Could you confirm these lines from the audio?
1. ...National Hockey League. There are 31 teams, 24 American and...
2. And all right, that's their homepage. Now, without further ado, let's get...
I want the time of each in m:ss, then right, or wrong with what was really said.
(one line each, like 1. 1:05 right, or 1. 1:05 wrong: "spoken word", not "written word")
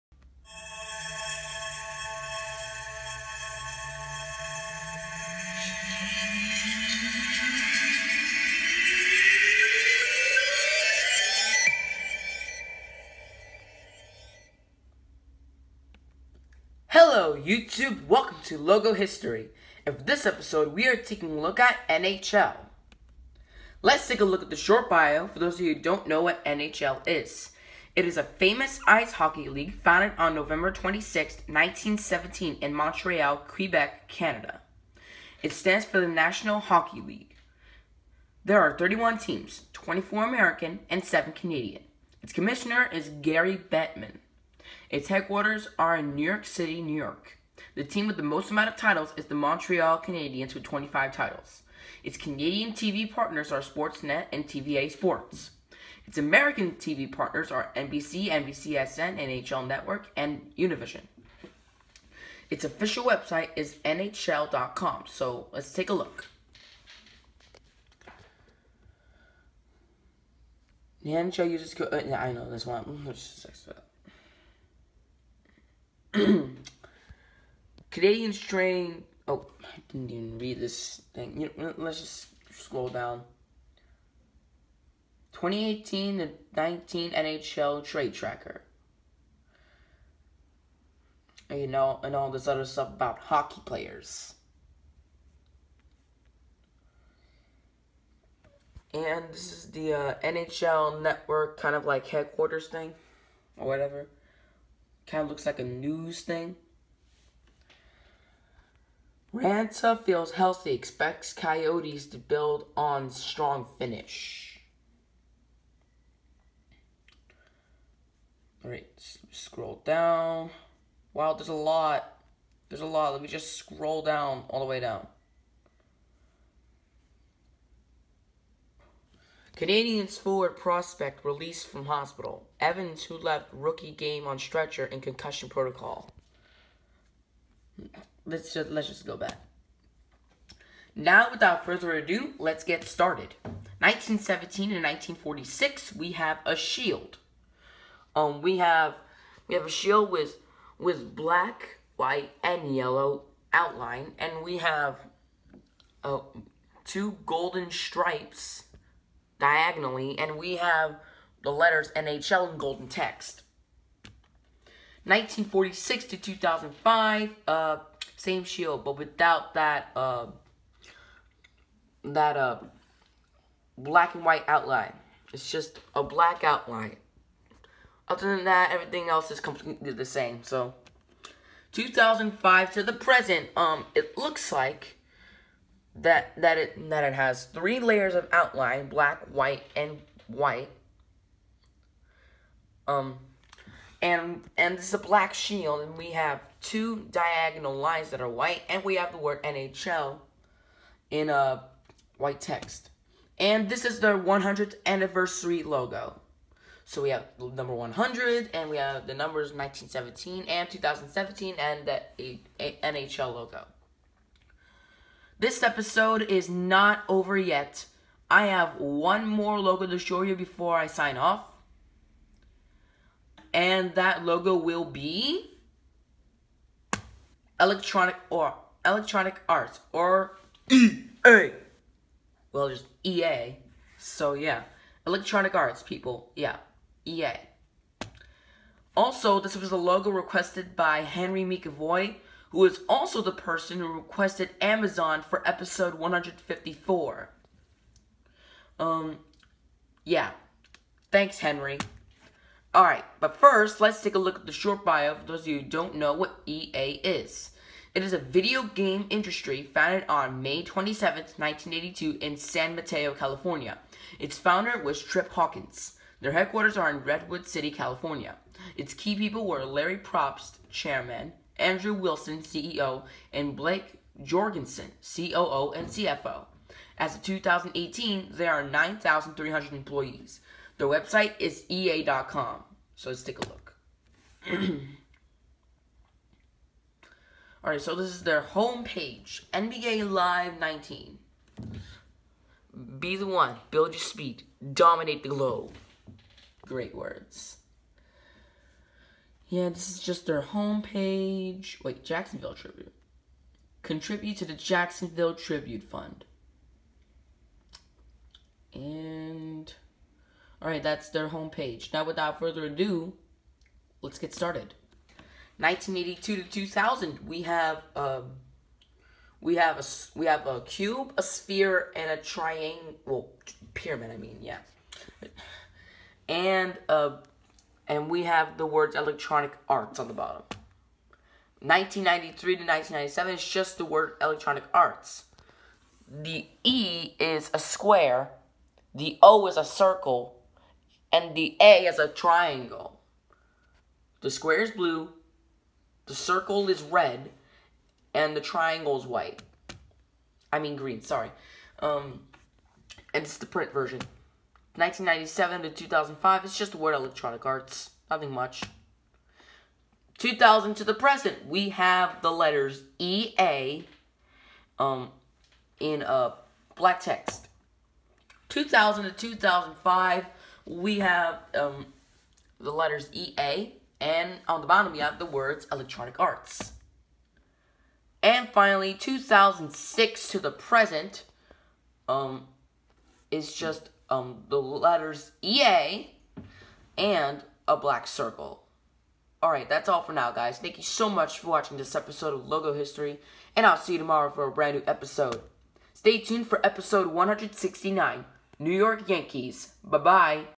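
1. 0:36 right
2. 5:08 right.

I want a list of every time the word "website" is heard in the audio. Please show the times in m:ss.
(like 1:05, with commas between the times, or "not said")
1:03, 4:40.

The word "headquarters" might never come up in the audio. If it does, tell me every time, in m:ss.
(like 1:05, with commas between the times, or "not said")
0:45, 1:42, 4:26.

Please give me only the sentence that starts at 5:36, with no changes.
The E is a square, the O is a circle, and the A is a triangle.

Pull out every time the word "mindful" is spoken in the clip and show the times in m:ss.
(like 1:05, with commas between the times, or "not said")
not said.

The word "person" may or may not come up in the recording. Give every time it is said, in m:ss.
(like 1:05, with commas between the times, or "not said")
4:03.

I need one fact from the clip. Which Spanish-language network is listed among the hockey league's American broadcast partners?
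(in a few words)
Univision.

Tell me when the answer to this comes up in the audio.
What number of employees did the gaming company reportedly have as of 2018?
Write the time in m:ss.
4:38.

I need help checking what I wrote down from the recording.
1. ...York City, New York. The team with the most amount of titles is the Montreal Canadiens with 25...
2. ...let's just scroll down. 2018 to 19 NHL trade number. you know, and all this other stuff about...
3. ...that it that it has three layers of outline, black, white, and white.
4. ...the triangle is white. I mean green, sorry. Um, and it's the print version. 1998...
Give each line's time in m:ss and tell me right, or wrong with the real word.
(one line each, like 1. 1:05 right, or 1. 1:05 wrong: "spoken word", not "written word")
1. 0:46 right
2. 1:21 wrong: "tracker", not "number"
3. 3:06 right
4. 5:48 wrong: "1997", not "1998".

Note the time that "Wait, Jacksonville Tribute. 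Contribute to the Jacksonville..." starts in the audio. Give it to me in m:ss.
5:01.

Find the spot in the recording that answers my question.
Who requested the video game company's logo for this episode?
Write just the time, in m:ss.
4:00.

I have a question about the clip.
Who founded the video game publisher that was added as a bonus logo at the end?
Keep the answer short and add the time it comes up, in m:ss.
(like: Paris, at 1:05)
Trip Hawkins, at 4:25.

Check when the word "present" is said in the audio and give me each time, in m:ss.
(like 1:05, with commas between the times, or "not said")
3:02, 6:00, 6:20.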